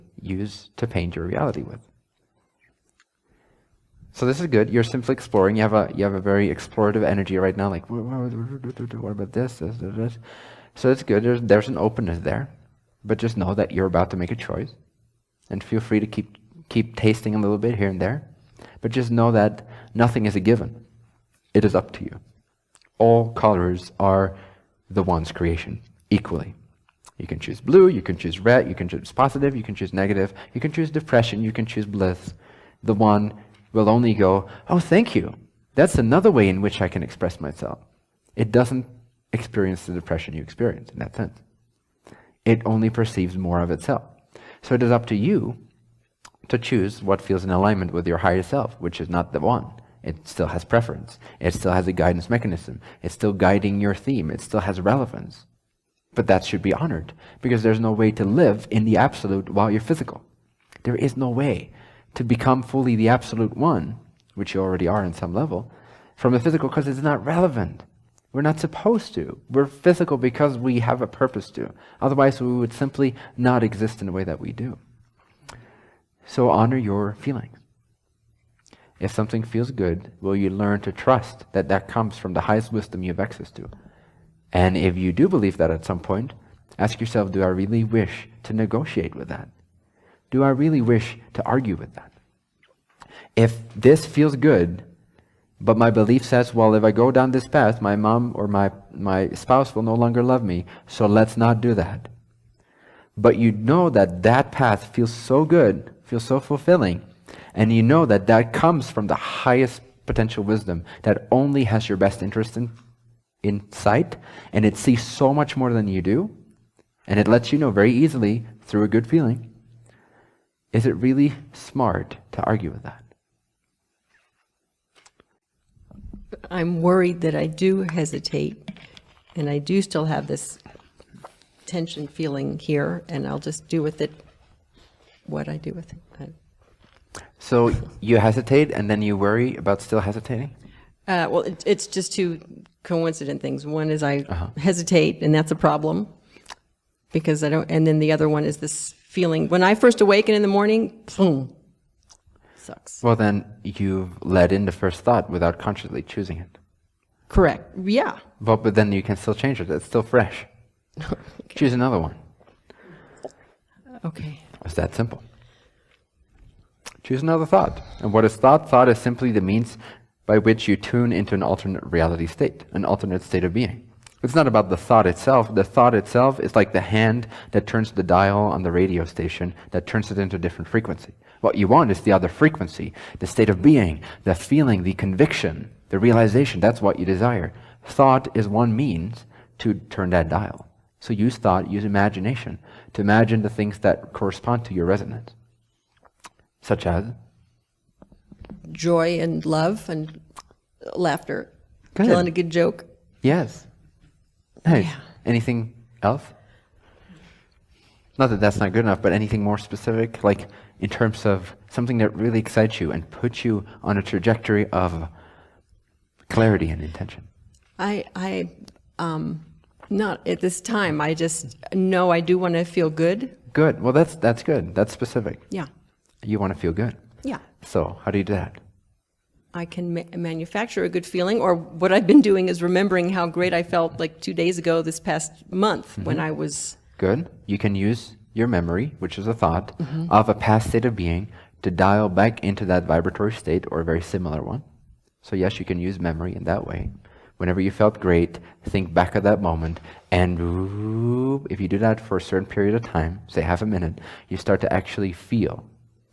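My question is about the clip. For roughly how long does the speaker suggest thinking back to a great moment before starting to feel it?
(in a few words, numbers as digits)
Half a minute.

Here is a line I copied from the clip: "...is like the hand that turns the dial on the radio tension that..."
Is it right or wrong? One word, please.
wrong.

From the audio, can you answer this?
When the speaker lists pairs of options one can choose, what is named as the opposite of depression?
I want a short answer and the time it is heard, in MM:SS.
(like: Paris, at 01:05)
Bliss, at 00:31.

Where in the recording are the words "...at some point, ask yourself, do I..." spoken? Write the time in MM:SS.
01:25.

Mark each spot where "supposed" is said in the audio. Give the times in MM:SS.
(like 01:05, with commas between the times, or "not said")
01:08.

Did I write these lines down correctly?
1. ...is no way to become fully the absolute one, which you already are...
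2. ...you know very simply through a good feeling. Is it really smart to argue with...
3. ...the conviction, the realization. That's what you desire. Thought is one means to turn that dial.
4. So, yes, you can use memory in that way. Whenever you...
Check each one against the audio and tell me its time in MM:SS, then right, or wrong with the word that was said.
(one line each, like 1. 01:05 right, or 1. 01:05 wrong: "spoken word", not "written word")
1. 01:01 right
2. 01:57 wrong: "easily", not "simply"
3. 03:04 right
4. 04:05 right.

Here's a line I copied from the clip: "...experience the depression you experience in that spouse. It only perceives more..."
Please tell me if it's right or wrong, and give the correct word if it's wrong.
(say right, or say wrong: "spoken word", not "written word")
wrong: "sense", not "spouse".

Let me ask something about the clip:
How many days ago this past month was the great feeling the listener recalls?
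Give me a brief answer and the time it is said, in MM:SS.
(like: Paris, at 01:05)
2, at 03:54.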